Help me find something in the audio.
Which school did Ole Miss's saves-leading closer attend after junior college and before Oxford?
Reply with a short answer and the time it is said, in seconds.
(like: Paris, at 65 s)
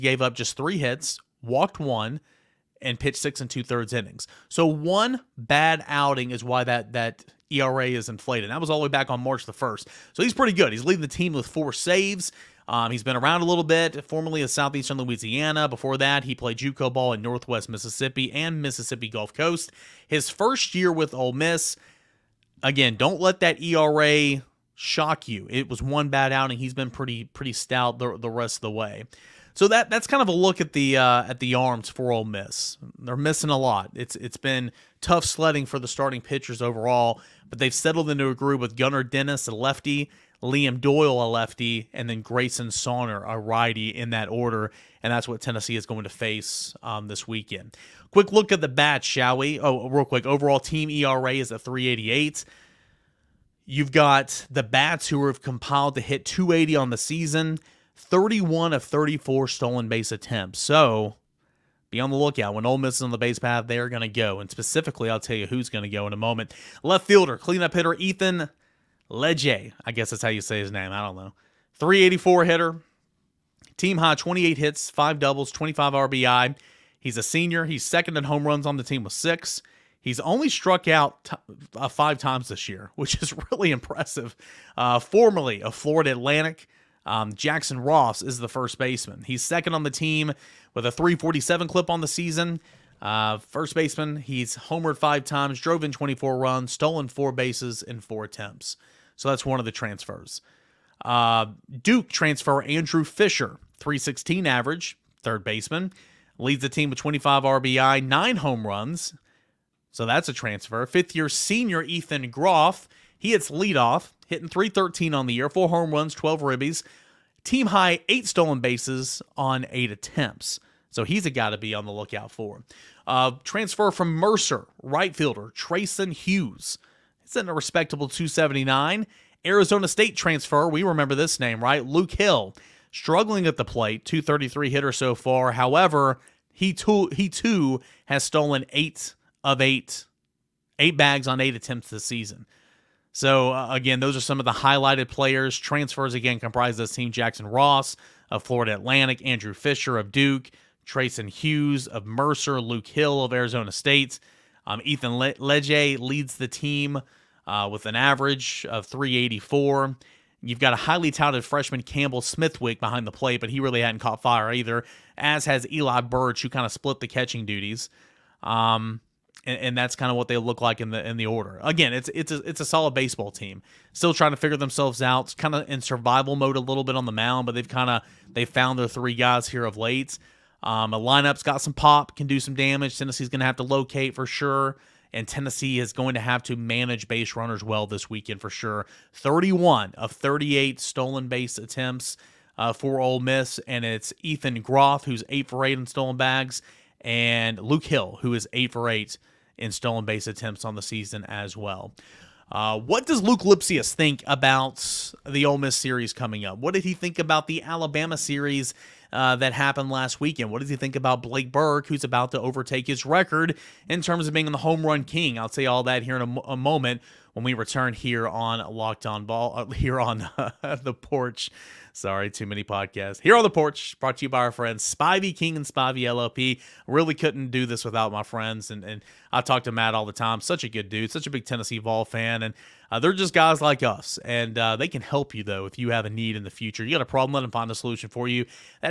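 Southeastern Louisiana, at 14 s.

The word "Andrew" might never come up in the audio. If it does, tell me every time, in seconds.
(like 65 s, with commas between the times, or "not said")
102 s, 149 s.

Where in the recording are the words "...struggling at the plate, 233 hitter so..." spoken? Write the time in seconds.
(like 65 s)
132 s.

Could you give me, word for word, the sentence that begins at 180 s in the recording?
Um, a lineup's got some pop, can do some damage.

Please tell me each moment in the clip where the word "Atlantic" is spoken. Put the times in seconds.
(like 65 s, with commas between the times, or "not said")
86 s, 148 s.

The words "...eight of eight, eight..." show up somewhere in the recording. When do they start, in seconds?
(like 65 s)
138 s.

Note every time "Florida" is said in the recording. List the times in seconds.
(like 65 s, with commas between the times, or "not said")
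85 s, 148 s.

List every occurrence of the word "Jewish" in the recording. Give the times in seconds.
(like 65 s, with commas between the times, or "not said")
not said.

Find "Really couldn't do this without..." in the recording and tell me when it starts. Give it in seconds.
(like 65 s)
226 s.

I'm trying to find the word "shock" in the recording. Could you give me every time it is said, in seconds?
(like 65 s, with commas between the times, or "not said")
24 s.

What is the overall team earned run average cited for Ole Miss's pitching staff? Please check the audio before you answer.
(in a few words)
3.88.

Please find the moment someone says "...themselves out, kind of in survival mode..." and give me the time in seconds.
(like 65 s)
174 s.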